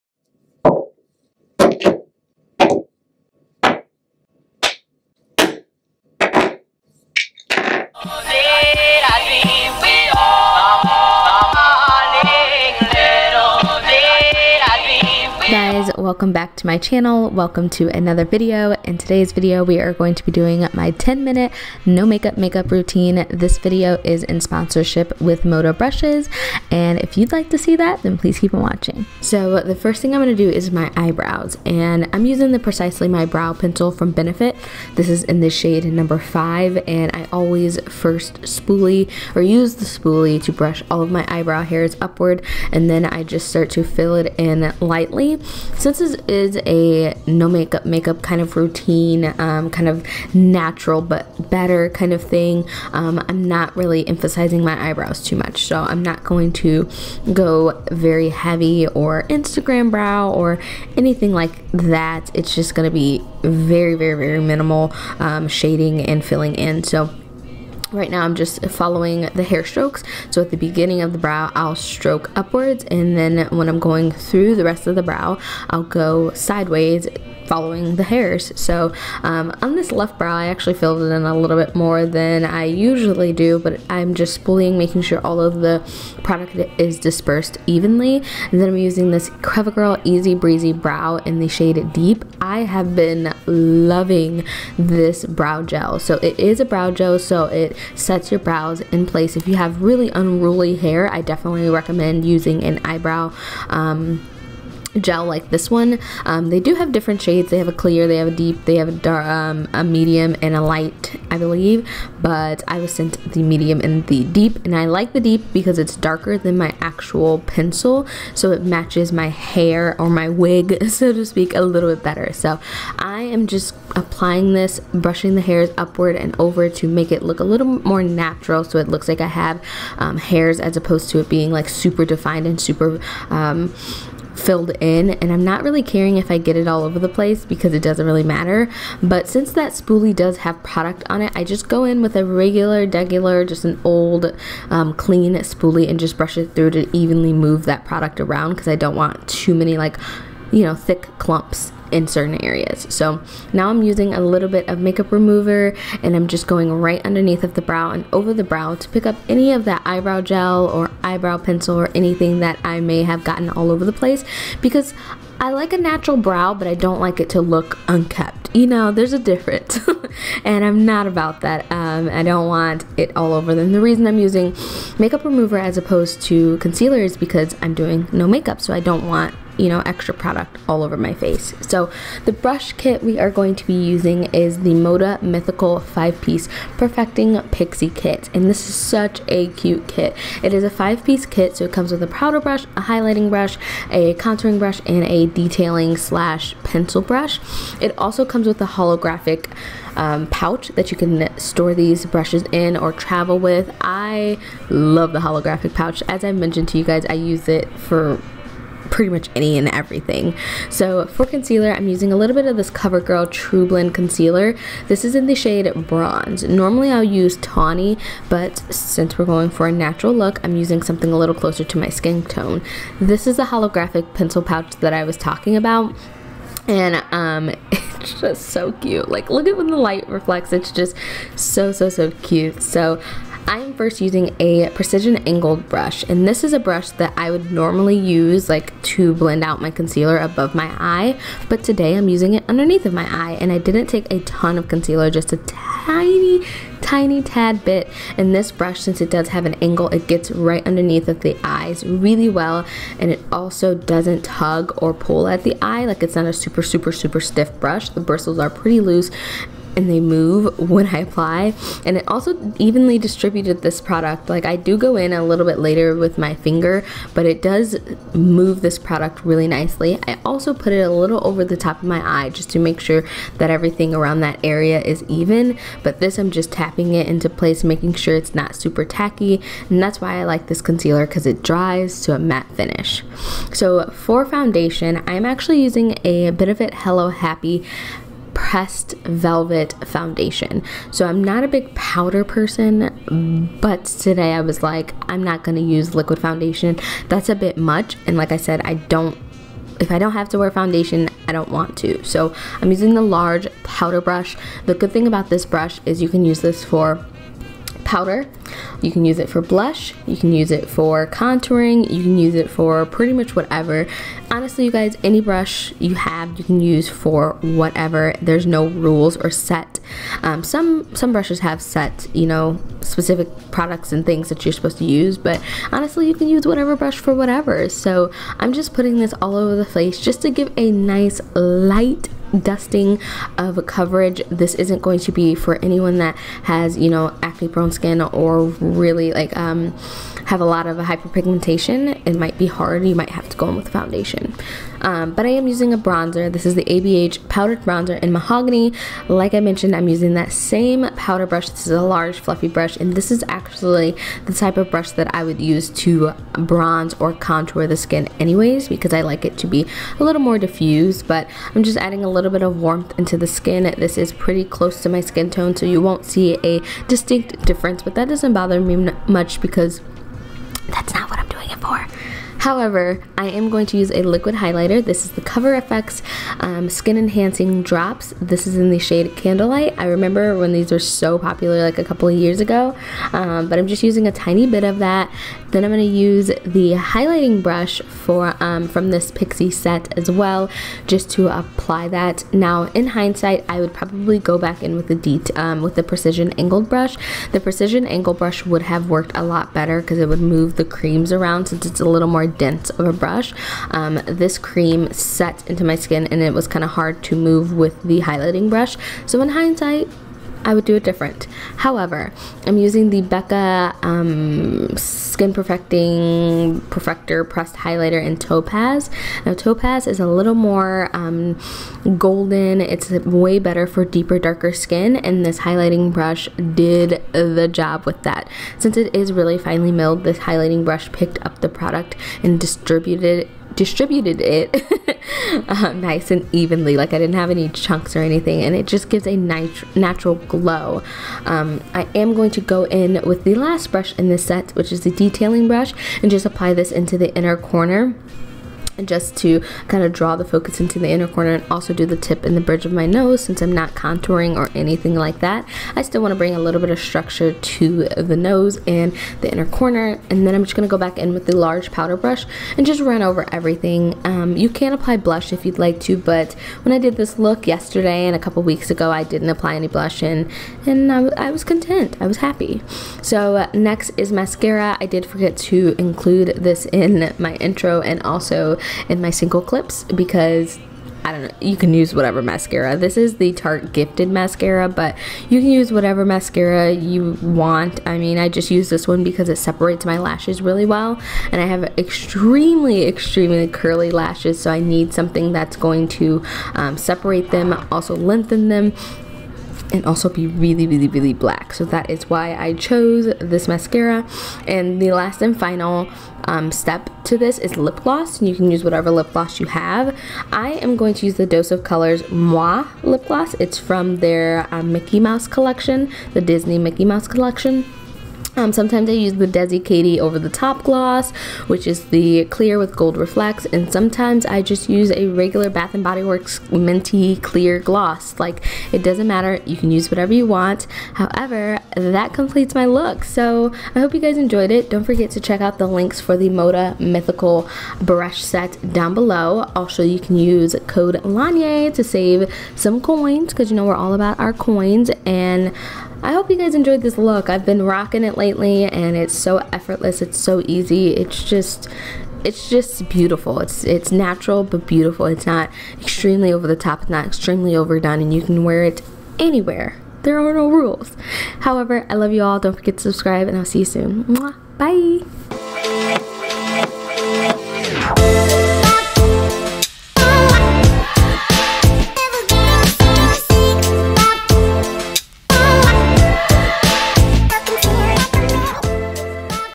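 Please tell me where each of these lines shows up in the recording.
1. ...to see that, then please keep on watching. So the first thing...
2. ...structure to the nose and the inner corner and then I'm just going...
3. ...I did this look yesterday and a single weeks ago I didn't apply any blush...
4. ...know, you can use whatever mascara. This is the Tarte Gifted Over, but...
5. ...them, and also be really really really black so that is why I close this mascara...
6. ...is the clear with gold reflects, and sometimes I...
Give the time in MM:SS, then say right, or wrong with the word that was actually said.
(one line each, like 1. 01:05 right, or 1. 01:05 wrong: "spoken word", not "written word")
1. 00:27 right
2. 07:36 right
3. 07:46 wrong: "couple", not "single"
4. 08:01 wrong: "Mascara", not "Over"
5. 08:18 wrong: "chose", not "close"
6. 08:41 right.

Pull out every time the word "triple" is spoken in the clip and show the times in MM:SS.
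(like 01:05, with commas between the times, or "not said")
not said.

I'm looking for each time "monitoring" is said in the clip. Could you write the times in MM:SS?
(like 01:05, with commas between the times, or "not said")
not said.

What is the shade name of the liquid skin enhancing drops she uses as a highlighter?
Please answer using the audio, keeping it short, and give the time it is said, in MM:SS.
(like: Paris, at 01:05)
Candlelight, at 06:19.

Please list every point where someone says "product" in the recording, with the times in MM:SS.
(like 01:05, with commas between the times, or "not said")
01:26, 02:20, 02:27, 03:00, 04:23, 04:28, 05:23, 07:11.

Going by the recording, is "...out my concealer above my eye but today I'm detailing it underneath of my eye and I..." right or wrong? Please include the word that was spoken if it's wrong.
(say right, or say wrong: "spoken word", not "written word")
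wrong: "using", not "detailing".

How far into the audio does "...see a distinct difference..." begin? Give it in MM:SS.
06:06.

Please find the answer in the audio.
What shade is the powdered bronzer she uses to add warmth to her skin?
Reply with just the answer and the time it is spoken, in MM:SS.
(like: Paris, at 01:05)
Mahogany, at 05:48.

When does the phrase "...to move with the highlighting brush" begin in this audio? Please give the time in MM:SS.
06:47.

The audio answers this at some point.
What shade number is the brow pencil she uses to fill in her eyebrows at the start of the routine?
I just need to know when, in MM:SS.
00:35.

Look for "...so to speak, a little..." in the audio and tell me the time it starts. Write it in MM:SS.
02:00.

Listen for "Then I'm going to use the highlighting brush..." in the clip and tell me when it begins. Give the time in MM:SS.
06:25.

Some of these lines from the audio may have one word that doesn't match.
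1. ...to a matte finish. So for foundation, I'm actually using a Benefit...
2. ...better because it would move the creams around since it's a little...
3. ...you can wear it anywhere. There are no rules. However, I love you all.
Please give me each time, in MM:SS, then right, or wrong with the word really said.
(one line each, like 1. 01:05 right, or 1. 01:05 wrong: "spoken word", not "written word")
1. 04:42 right
2. 06:39 right
3. 09:18 right.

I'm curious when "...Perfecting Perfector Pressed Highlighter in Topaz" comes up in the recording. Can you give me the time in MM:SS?
06:55.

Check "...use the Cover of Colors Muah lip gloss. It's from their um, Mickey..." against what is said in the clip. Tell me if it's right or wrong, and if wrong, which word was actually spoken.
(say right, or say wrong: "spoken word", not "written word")
wrong: "Dose", not "Cover".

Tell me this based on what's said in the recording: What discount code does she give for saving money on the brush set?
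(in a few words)
LONYEA.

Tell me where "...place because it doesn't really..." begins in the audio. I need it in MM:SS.
02:17.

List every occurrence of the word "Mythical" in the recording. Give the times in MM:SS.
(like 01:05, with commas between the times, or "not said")
03:05, 08:56.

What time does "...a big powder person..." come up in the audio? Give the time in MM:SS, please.
04:51.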